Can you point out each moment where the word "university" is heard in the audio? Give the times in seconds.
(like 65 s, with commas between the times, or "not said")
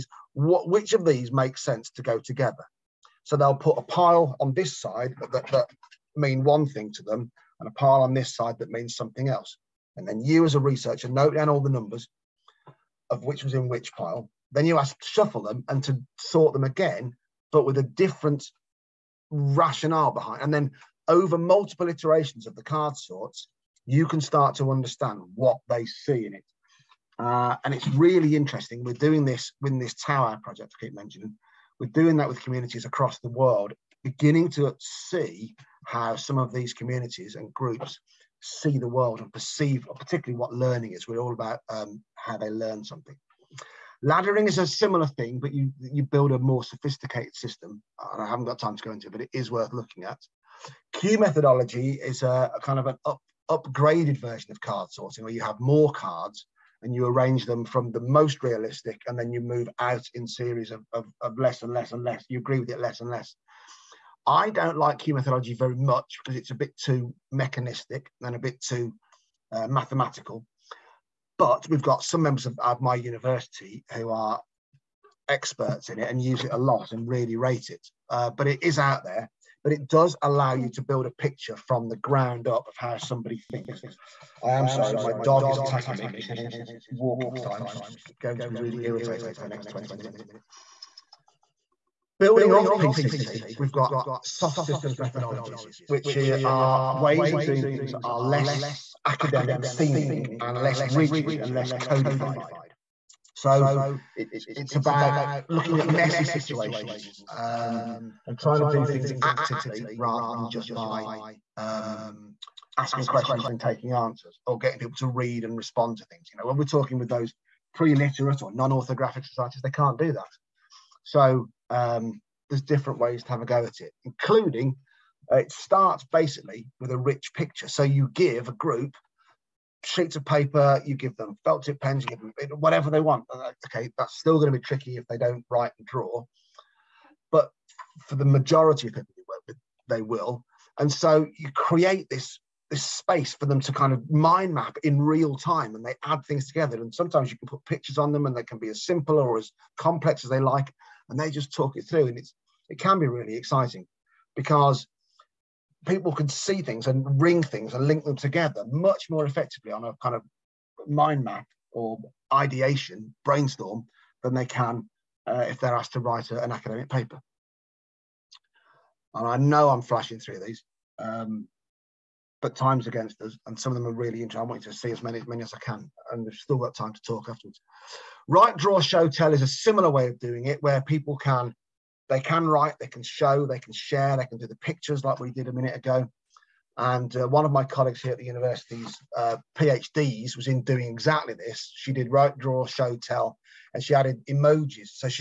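72 s, 188 s.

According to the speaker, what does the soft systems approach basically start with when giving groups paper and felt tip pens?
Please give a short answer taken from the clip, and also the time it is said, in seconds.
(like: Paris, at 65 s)
A rich picture, at 126 s.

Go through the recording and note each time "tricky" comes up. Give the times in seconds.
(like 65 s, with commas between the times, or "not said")
134 s.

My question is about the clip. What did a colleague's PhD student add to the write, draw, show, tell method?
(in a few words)
Emojis.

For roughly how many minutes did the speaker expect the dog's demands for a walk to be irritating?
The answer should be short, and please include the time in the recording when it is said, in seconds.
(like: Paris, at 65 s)
20 minutes, at 89 s.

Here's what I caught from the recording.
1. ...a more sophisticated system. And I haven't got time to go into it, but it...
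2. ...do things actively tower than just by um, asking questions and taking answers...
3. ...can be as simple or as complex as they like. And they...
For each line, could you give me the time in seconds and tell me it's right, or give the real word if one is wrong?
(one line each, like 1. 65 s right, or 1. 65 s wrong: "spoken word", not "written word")
1. 46 s right
2. 108 s wrong: "rather", not "tower"
3. 148 s right.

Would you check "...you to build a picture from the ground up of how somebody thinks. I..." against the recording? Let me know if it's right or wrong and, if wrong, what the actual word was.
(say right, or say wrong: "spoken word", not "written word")
right.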